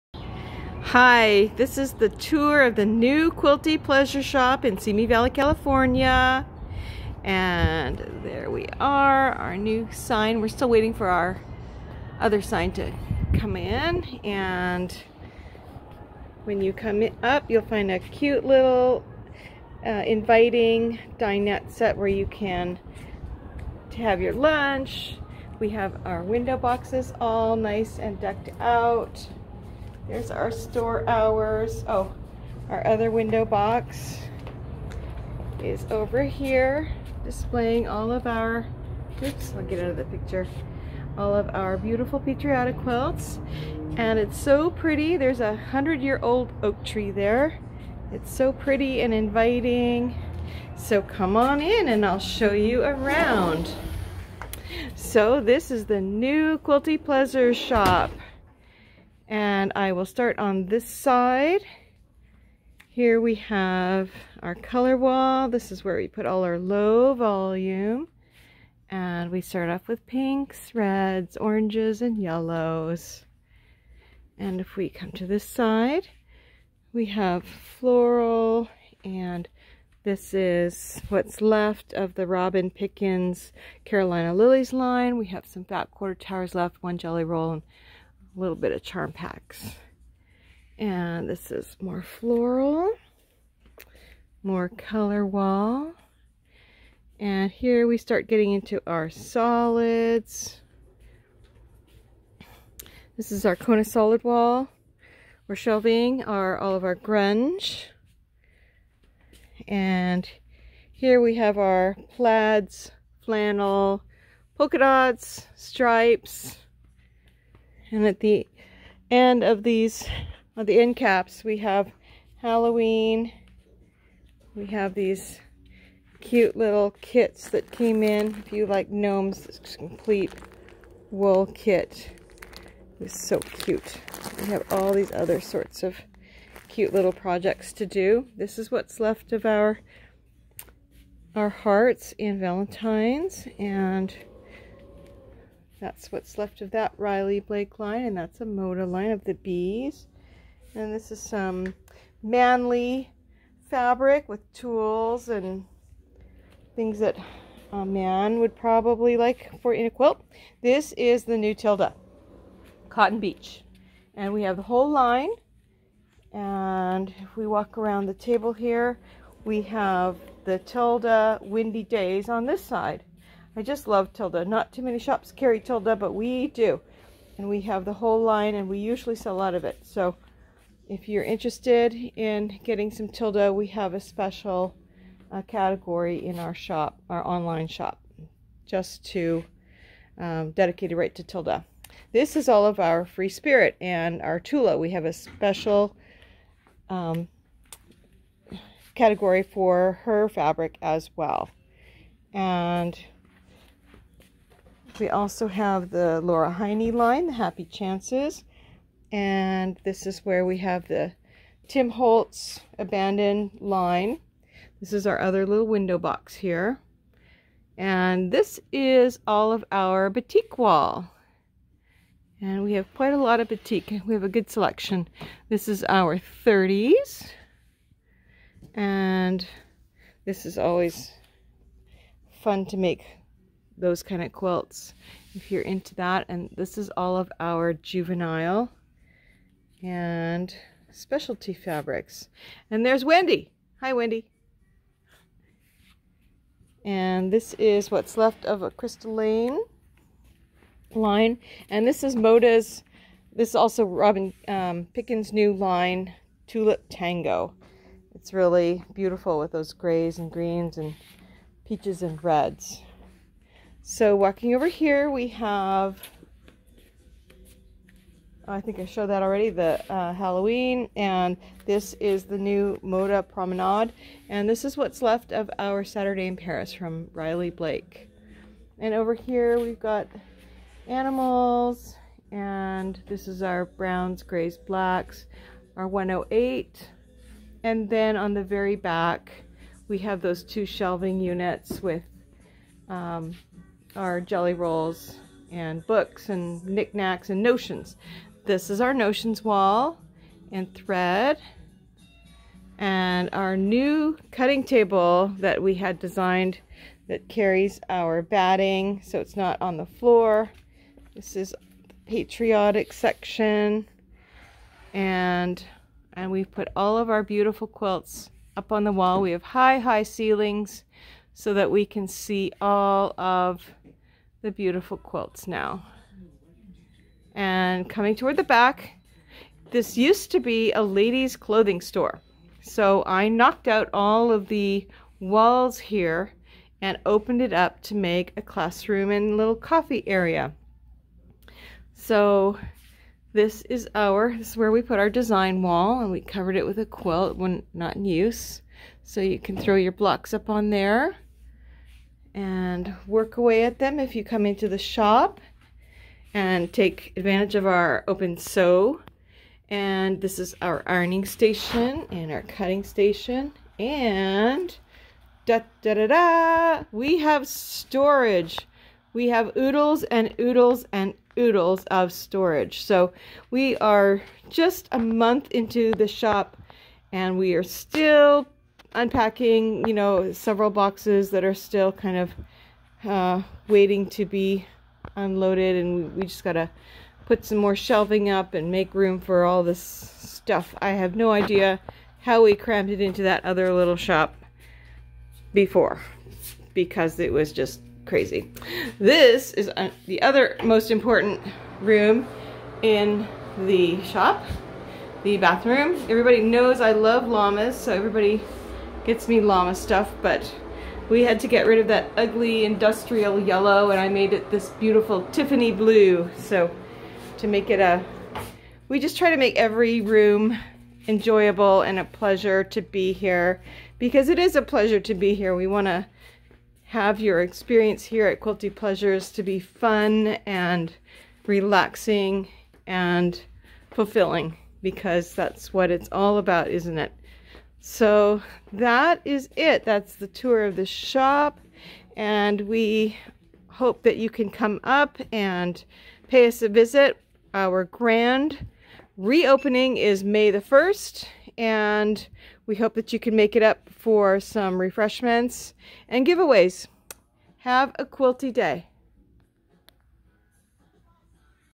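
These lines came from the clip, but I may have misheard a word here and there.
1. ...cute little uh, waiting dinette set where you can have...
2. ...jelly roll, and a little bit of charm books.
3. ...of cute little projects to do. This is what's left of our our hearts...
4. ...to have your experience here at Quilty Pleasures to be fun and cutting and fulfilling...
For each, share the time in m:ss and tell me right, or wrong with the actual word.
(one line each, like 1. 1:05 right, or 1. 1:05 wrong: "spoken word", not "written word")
1. 0:17 wrong: "inviting", not "waiting"
2. 1:26 wrong: "packs", not "books"
3. 2:15 right
4. 7:05 wrong: "relaxing", not "cutting".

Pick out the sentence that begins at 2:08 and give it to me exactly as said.
If you like gnomes, it's complete wool kit.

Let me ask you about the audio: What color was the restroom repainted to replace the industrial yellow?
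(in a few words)
Tiffany blue.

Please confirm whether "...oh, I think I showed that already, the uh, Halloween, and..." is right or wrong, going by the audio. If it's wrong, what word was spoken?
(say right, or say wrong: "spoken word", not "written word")
right.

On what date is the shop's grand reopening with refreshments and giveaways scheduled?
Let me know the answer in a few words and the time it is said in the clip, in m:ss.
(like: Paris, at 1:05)
May 1, at 7:30.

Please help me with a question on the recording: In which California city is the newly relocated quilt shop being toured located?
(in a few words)
Simi Valley.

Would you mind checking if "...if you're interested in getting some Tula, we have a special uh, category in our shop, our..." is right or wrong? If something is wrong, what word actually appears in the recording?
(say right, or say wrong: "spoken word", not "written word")
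wrong: "Tilda", not "Tula".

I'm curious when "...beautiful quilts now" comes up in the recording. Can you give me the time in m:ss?
5:24.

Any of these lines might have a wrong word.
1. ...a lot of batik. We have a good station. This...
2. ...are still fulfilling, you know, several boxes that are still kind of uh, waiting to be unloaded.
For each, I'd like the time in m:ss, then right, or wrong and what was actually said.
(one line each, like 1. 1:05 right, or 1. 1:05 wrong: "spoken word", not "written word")
1. 3:43 wrong: "selection", not "station"
2. 6:17 wrong: "unpacking", not "fulfilling".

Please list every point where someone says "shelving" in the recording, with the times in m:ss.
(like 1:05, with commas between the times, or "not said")
1:45, 4:50, 6:27.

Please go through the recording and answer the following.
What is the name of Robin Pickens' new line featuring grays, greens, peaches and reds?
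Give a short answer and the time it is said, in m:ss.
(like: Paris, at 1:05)
Tulip Tango, at 4:16.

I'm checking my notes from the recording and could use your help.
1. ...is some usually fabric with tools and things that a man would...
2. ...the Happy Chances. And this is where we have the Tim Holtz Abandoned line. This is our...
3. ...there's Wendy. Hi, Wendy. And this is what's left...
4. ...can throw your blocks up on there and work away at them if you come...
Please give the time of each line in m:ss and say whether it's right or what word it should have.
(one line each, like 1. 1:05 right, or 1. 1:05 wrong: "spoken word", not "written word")
1. 2:31 wrong: "manly", not "usually"
2. 3:27 right
3. 4:02 right
4. 5:49 right.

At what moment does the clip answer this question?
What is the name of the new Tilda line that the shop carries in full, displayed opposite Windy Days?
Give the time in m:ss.
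2:42.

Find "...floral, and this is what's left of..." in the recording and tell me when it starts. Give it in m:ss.
1:17.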